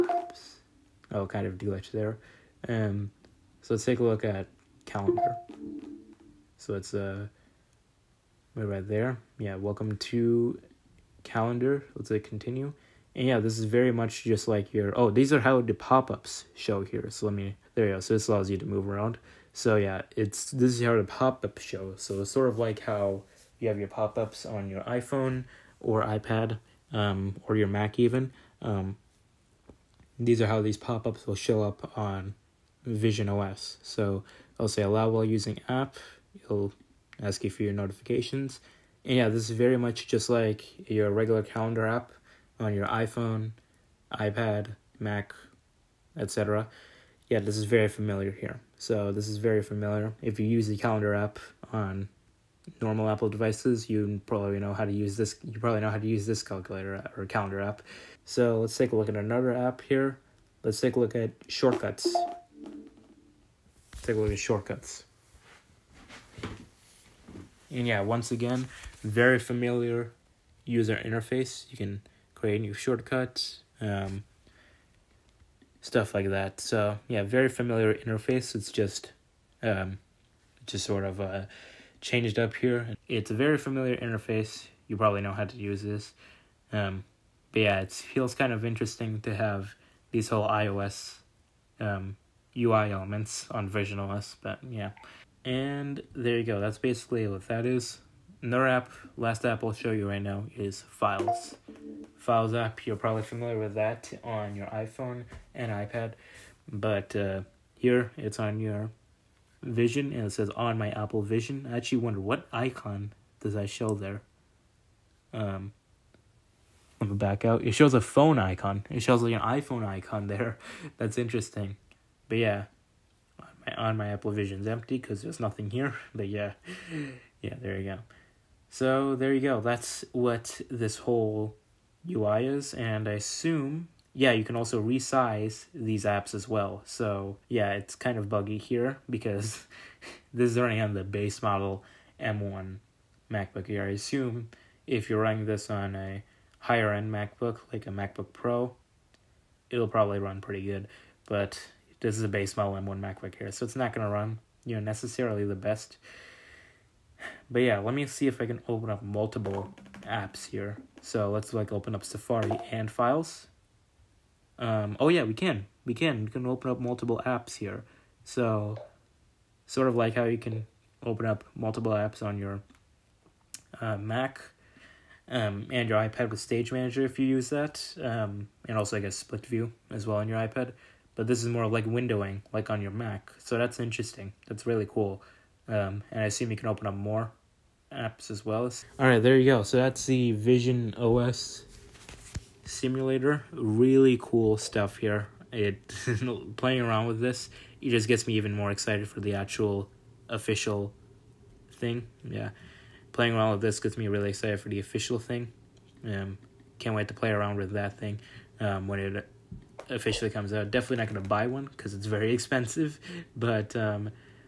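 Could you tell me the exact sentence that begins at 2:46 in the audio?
We can open up multiple apps here.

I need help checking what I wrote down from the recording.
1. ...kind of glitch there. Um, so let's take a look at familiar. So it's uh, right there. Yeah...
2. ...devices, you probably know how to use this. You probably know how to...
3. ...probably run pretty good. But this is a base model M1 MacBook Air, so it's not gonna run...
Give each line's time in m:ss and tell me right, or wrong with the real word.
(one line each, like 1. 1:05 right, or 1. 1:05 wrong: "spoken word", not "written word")
1. 0:01 wrong: "calendar", not "familiar"
2. 0:53 right
3. 2:29 right.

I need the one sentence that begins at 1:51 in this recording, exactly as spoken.
I actually wonder what icon does I show there.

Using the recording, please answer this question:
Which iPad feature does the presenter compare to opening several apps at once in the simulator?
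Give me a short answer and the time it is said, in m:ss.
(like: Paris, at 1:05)
Stage Manager, at 2:56.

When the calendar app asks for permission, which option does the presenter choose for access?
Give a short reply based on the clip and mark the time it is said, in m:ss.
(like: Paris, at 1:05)
Allow while using app, at 0:34.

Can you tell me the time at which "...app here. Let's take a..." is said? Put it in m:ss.
0:59.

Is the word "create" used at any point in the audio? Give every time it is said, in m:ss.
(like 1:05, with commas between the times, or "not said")
1:12.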